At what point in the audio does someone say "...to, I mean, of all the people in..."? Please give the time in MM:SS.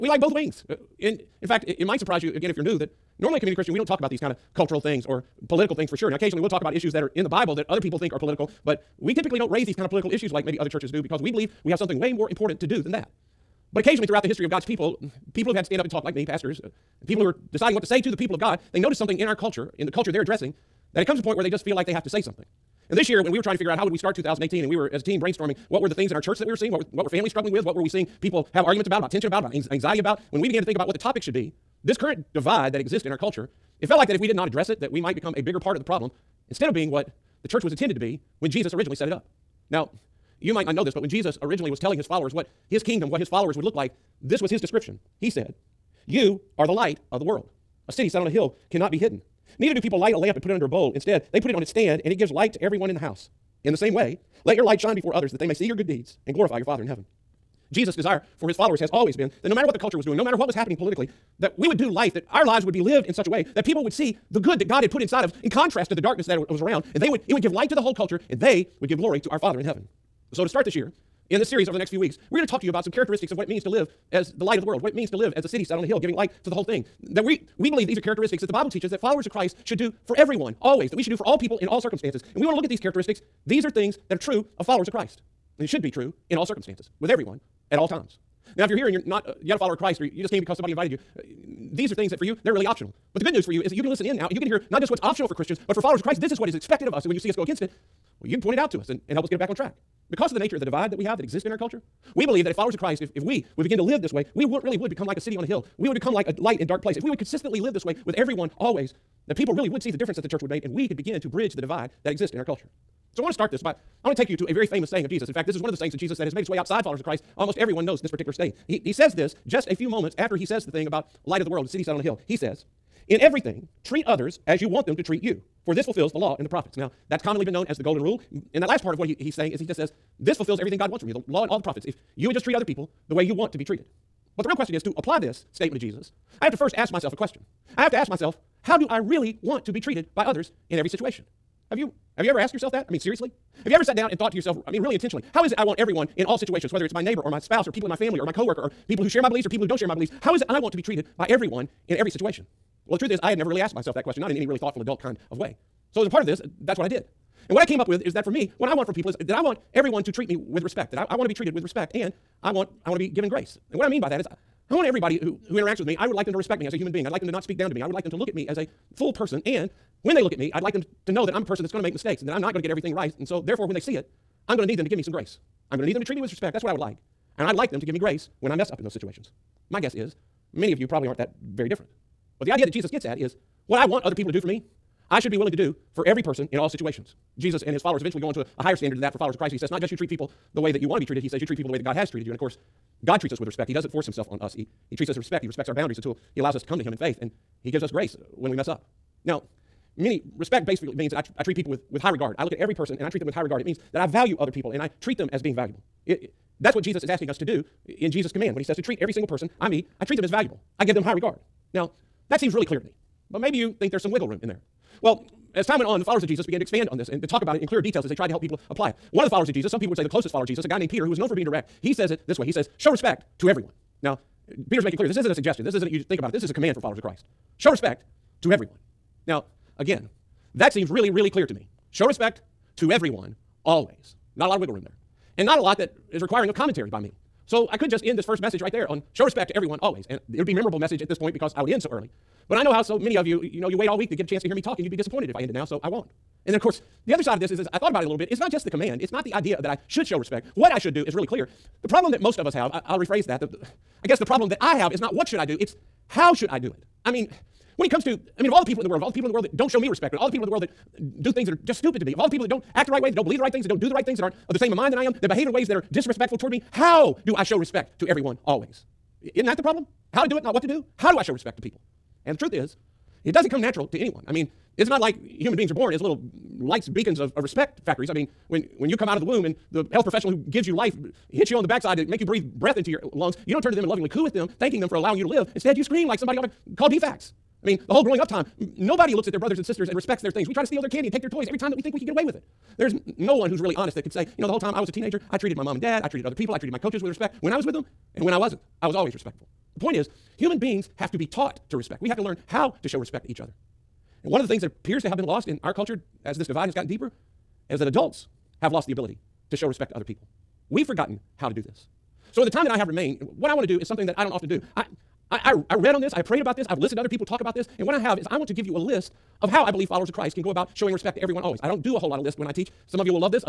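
04:18.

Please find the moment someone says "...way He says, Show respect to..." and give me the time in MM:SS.
03:42.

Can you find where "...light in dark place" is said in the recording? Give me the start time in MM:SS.
01:46.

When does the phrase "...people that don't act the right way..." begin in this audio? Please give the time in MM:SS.
04:22.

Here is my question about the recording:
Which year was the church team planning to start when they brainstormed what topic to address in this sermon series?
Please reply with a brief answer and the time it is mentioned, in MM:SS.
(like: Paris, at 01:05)
2018, at 00:24.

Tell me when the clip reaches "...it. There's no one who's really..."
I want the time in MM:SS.
04:52.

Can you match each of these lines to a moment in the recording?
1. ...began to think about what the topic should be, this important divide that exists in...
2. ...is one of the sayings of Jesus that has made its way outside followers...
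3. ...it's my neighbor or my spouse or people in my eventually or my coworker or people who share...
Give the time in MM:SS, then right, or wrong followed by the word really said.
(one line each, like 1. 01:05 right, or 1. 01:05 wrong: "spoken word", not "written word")
1. 00:30 wrong: "current", not "important"
2. 01:55 right
3. 02:26 wrong: "family", not "eventually".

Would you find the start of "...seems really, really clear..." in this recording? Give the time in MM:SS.
03:50.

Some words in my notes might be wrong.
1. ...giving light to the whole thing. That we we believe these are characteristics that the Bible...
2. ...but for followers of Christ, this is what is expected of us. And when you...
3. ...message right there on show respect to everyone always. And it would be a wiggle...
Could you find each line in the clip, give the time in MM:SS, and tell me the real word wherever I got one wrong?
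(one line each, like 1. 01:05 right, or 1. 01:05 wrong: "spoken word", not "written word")
1. 01:15 right
2. 01:35 right
3. 03:58 wrong: "memorable", not "wiggle".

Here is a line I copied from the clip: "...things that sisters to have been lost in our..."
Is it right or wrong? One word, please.
wrong.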